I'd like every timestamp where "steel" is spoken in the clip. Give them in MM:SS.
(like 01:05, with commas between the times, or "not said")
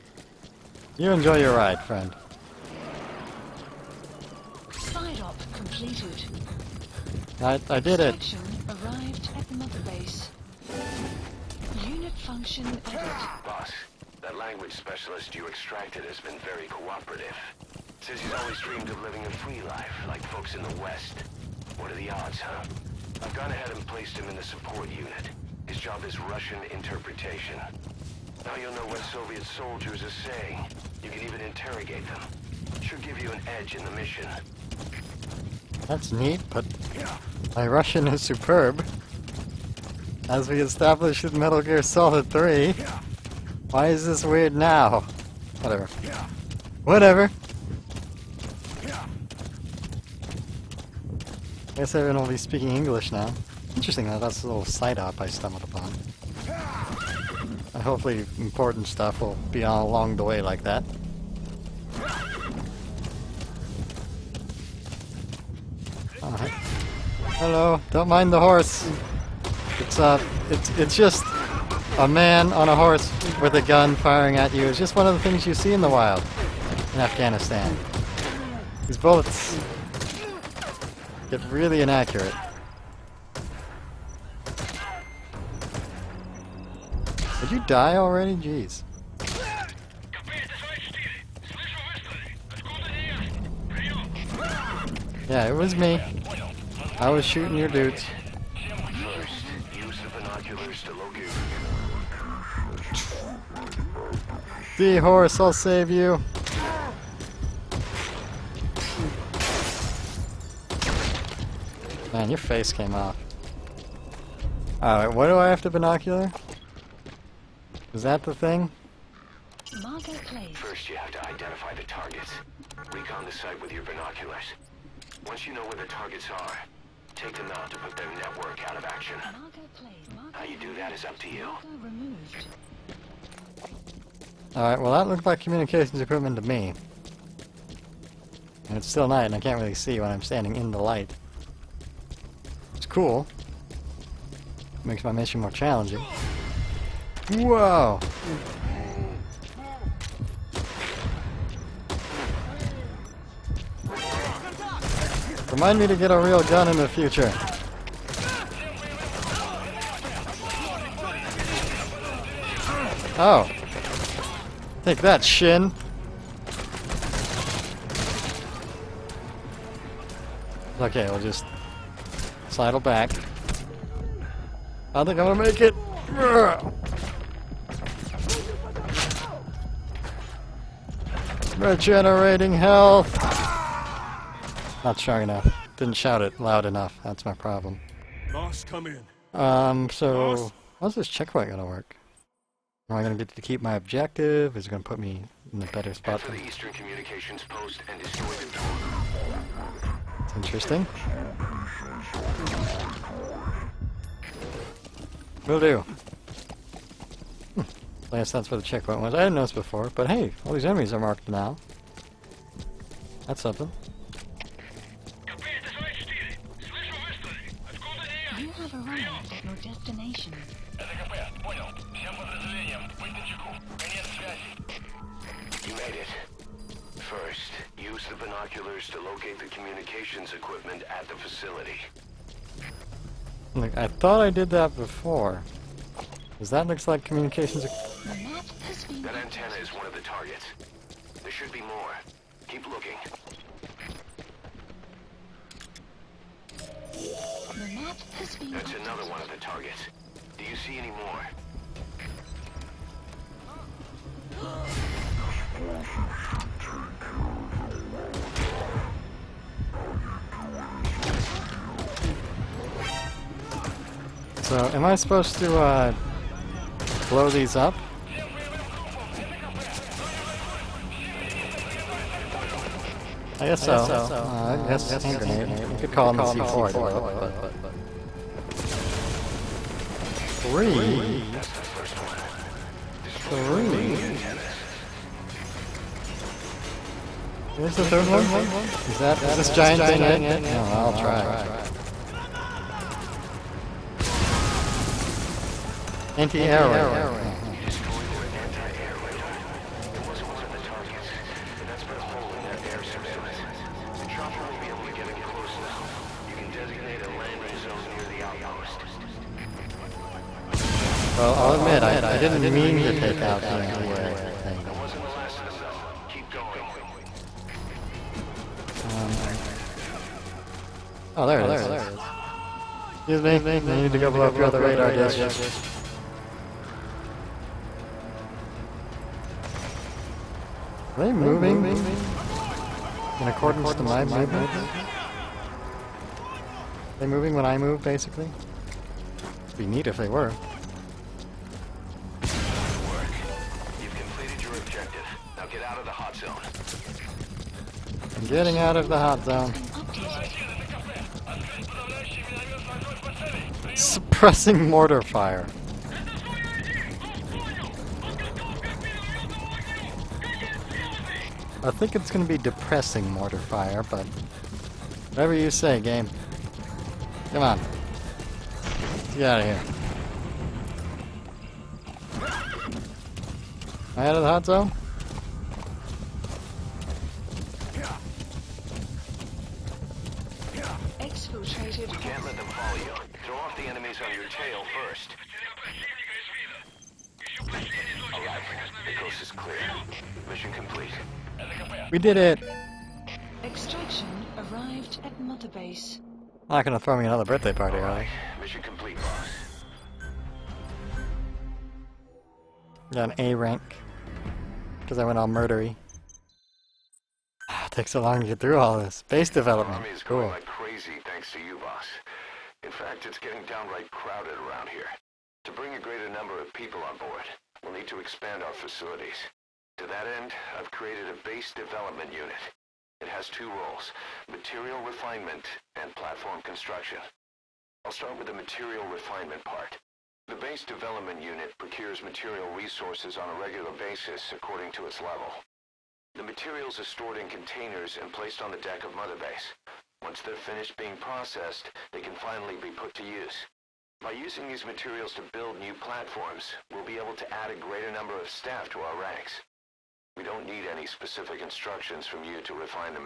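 not said.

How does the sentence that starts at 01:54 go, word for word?
Alright, what do I have to binocular?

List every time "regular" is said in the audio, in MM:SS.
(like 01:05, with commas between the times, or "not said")
07:13.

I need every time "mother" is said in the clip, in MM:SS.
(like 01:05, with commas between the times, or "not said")
00:09, 06:35, 07:18.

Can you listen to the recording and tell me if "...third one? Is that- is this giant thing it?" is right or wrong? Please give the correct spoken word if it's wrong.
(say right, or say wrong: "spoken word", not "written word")
right.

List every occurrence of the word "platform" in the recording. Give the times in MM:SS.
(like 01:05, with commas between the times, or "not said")
07:05, 07:25.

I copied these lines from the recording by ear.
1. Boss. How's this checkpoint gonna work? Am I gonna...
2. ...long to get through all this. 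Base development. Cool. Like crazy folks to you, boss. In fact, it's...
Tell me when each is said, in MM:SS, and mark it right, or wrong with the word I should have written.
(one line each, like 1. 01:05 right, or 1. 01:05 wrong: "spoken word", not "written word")
1. 03:10 right
2. 06:48 wrong: "thanks", not "folks".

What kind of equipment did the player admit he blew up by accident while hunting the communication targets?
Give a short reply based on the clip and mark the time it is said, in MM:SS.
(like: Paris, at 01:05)
Anti-air radar, at 04:56.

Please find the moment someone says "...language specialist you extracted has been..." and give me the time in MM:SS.
00:14.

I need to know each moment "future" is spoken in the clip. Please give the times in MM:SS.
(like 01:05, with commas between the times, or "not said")
02:36.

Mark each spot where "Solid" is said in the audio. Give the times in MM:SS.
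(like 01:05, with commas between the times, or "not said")
00:41.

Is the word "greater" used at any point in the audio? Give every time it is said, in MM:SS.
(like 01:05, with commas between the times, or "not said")
06:55, 07:27.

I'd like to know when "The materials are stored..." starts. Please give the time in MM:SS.
07:16.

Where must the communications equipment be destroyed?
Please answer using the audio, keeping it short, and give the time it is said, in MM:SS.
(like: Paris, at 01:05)
Eastern Communications Post, at 03:16.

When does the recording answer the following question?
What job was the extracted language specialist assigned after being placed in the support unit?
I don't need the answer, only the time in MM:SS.
00:26.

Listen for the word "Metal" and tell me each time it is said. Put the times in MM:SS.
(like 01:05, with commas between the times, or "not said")
00:41.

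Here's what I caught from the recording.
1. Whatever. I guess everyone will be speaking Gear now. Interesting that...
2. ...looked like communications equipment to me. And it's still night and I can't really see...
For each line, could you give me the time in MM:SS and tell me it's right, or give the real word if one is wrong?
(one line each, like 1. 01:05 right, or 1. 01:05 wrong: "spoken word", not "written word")
1. 00:46 wrong: "English", not "Gear"
2. 02:15 right.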